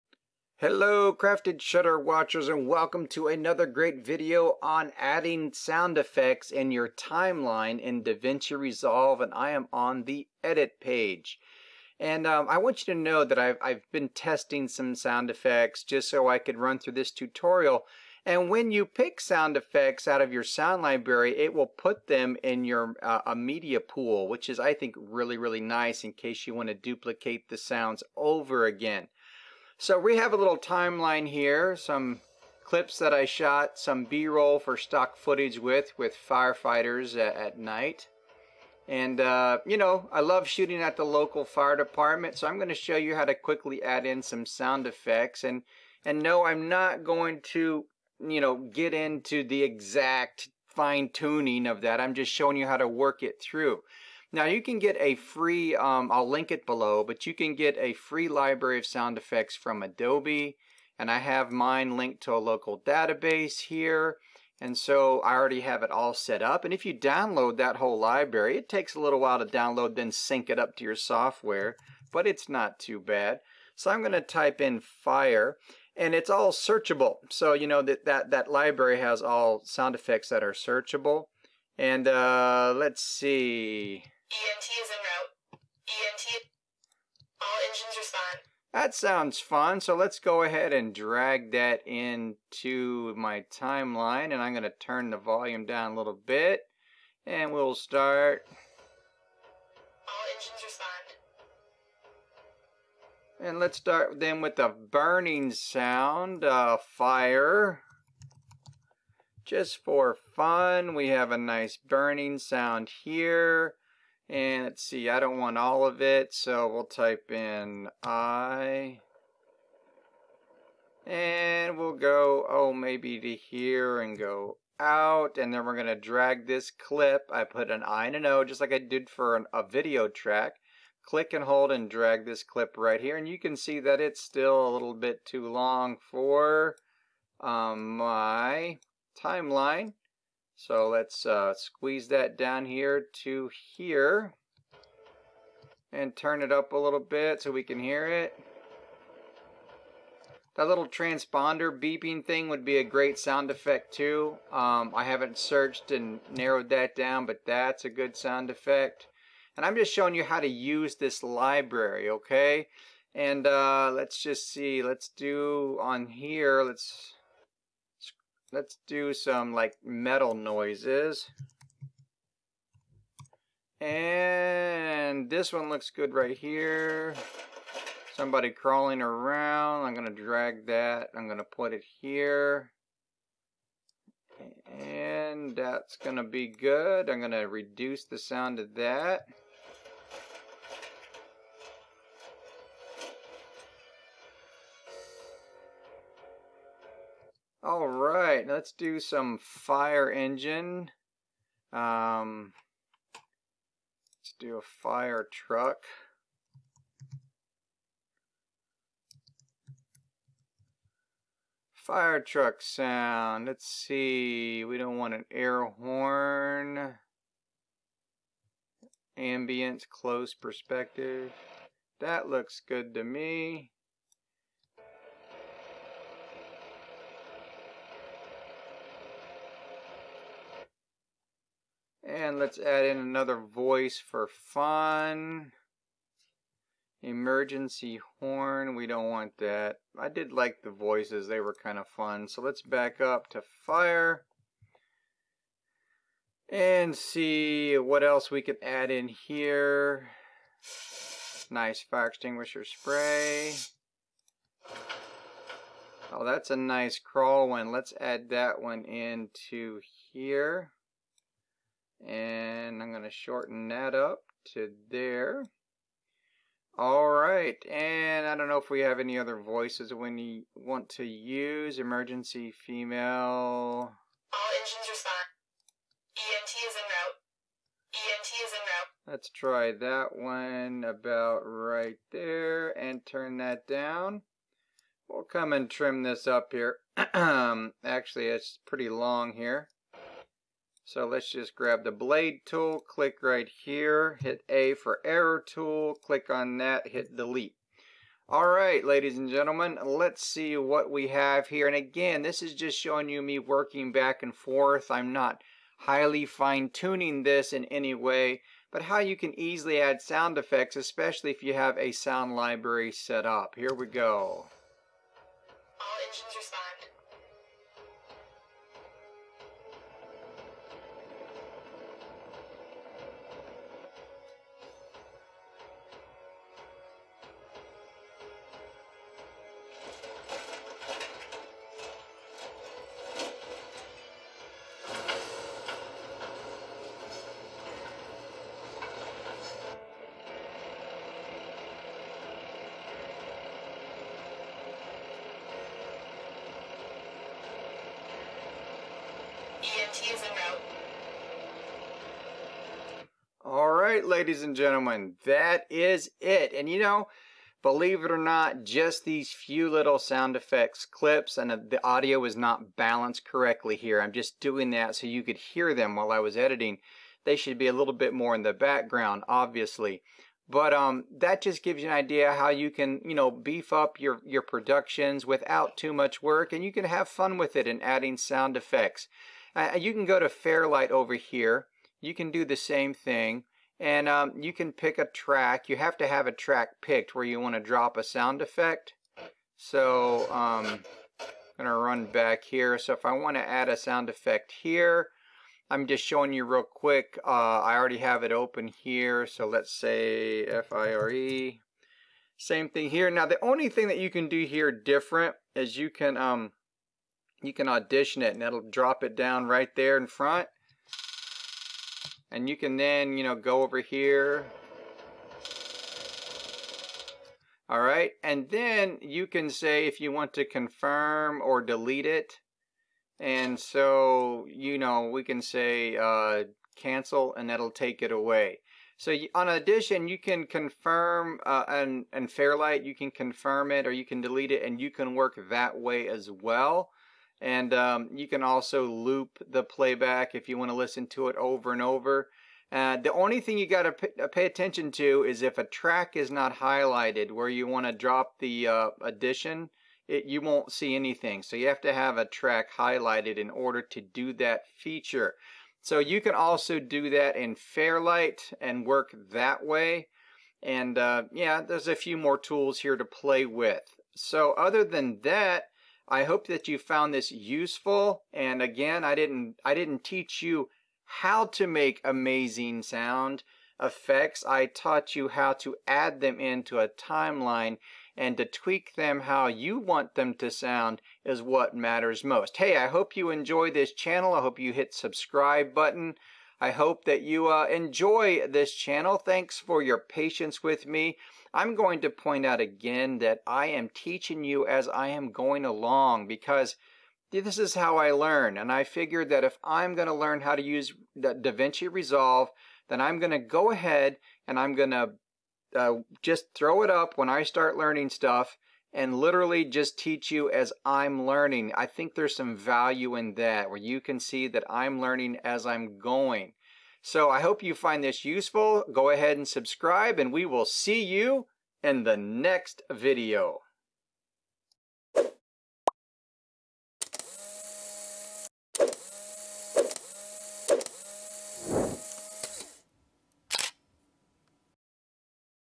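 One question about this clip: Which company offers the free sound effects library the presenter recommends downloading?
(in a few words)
Adobe.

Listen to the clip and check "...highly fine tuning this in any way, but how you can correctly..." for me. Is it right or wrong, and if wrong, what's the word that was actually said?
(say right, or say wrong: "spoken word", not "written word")
wrong: "easily", not "correctly".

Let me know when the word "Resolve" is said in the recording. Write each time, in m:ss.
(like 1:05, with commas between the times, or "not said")
0:08, 8:21.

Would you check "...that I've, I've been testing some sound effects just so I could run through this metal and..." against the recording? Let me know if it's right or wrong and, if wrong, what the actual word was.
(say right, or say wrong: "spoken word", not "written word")
wrong: "tutorial", not "metal".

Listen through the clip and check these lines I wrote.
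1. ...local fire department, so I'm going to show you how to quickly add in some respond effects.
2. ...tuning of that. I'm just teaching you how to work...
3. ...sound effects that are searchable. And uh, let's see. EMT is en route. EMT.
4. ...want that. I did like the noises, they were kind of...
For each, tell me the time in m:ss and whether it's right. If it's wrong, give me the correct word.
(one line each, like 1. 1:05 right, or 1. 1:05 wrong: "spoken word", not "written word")
1. 0:41 wrong: "sound", not "respond"
2. 0:51 wrong: "showing", not "teaching"
3. 1:19 right
4. 3:59 wrong: "voices", not "noises".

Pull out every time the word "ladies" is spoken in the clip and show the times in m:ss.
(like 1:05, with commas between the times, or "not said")
4:58, 5:54.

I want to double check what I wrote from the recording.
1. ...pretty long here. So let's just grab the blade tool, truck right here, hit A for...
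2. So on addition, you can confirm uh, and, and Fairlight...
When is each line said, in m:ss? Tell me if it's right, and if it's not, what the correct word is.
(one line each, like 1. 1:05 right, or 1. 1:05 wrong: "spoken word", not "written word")
1. 4:48 wrong: "click", not "truck"
2. 7:08 wrong: "audition", not "addition".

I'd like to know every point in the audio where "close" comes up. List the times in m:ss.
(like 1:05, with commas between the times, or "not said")
3:39.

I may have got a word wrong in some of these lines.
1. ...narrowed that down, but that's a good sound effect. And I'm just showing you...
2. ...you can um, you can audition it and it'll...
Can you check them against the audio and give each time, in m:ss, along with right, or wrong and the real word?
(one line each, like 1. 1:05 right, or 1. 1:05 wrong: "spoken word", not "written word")
1. 2:36 right
2. 6:45 right.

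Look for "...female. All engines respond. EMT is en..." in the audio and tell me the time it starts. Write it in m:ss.
4:32.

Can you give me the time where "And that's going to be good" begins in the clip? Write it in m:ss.
3:04.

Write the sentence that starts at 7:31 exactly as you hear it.
So you have to have a track highlighted in order to do that feature.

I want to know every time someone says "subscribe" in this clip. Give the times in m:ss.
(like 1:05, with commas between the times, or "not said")
8:04, 8:39.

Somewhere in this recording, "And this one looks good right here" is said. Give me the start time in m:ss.
2:53.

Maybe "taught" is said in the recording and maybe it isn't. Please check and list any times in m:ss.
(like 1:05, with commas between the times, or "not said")
7:54.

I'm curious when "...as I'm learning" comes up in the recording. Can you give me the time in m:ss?
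8:30.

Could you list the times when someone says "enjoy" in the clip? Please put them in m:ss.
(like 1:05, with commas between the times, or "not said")
8:03, 8:07.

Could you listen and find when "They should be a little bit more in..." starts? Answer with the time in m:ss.
6:07.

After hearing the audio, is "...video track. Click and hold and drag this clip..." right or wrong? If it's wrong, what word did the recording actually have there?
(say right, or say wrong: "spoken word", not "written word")
right.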